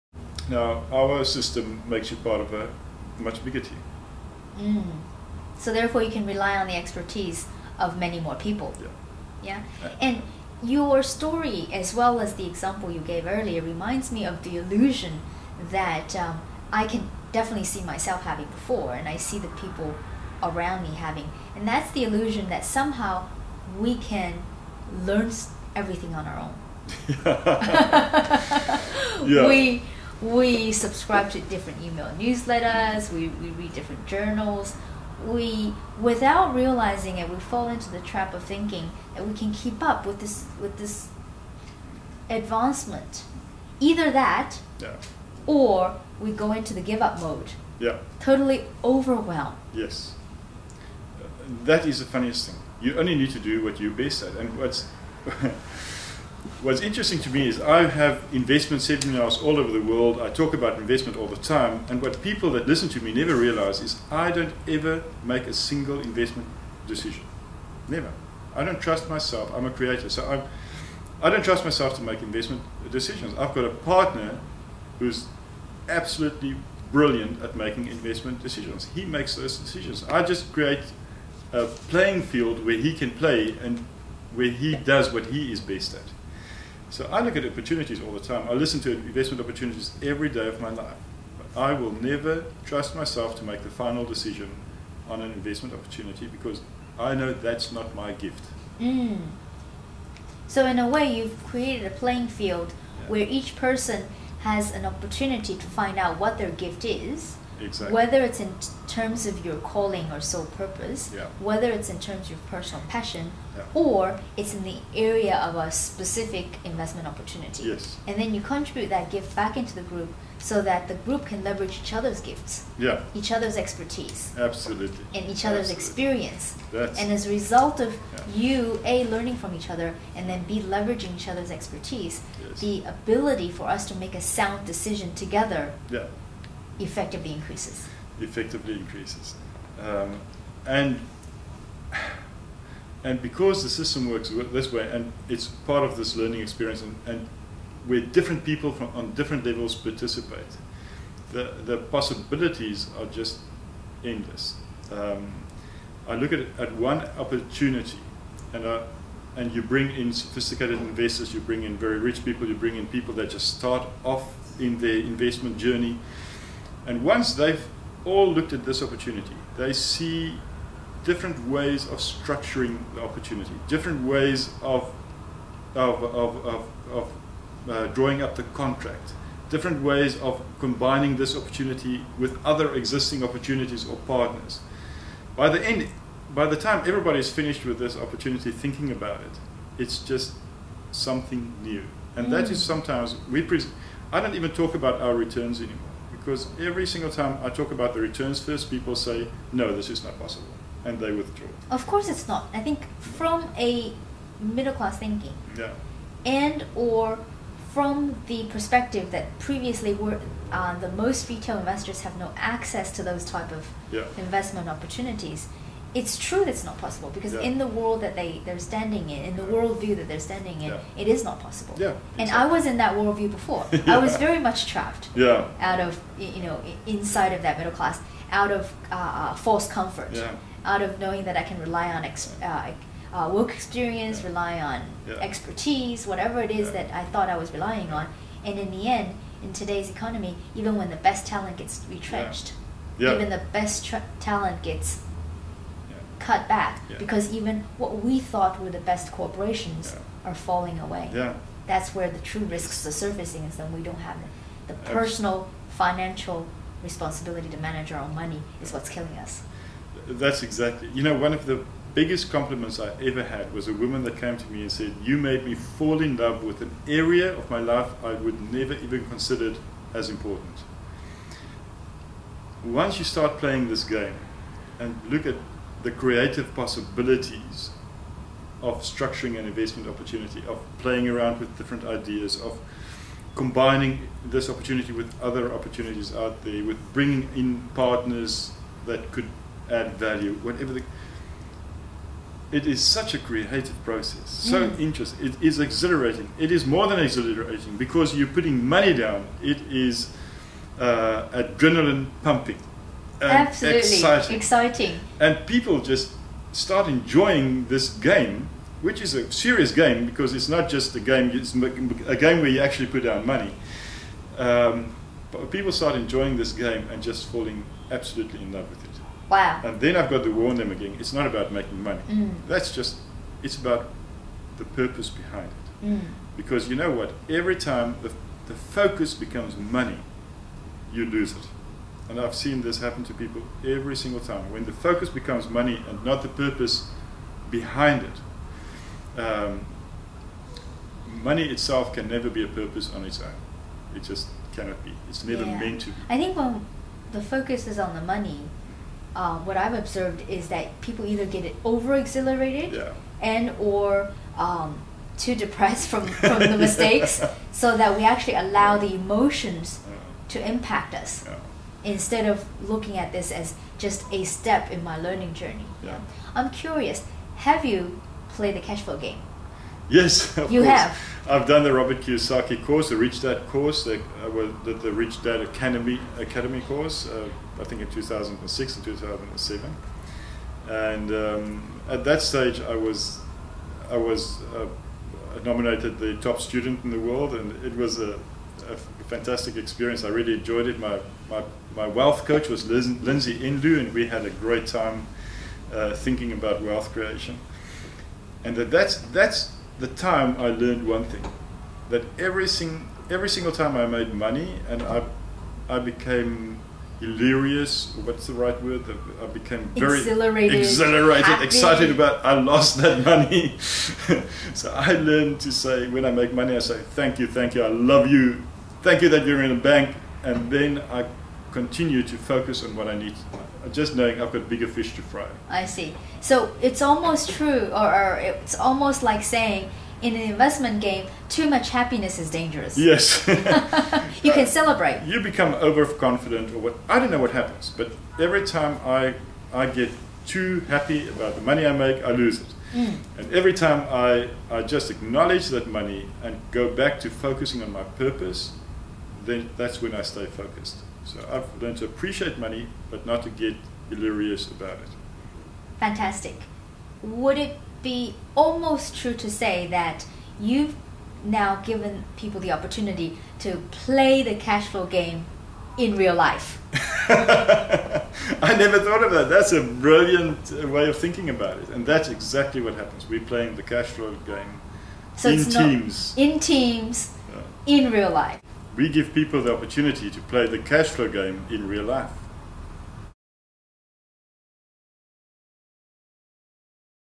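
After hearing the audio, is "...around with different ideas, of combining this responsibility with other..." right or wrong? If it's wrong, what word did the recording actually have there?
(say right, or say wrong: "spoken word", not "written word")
wrong: "opportunity", not "responsibility".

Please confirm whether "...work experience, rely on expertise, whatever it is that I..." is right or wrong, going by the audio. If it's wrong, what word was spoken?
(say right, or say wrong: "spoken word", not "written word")
right.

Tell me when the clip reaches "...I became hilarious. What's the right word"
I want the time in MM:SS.
06:45.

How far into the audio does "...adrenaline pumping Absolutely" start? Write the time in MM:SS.
05:01.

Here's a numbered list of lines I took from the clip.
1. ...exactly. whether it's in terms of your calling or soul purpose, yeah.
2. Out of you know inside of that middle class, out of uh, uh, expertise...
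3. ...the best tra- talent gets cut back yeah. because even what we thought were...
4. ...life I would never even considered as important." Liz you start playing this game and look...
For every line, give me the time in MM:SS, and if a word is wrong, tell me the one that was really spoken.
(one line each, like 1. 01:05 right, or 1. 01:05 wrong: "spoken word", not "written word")
1. 01:47 right
2. 03:45 wrong: "false", not "expertise"
3. 04:03 right
4. 04:27 wrong: "Once", not "Liz".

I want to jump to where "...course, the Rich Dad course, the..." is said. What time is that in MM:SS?
06:12.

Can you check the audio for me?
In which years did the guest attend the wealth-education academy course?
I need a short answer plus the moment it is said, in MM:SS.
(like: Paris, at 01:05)
2006 and 2007, at 06:17.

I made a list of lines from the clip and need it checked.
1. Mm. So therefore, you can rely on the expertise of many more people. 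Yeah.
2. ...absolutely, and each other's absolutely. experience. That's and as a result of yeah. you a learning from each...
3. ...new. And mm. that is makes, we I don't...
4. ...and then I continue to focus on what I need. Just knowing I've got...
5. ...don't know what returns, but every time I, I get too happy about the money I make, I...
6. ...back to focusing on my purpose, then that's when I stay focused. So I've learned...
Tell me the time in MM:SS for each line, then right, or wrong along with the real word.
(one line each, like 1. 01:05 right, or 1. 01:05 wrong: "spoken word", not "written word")
1. 00:04 right
2. 02:04 right
3. 03:11 wrong: "sometimes", not "makes"
4. 07:00 right
5. 07:16 wrong: "happens", not "returns"
6. 07:26 right.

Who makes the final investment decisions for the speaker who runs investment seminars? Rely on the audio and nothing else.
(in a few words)
A partner.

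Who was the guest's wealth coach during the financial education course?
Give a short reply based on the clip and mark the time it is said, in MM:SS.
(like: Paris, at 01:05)
Liz, at 06:32.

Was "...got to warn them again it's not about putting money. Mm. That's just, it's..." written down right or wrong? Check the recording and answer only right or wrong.
wrong.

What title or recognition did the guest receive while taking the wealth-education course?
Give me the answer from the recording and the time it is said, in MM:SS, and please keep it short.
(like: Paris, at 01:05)
Top student in the world, at 06:26.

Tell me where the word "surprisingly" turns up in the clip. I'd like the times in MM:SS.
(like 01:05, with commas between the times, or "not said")
not said.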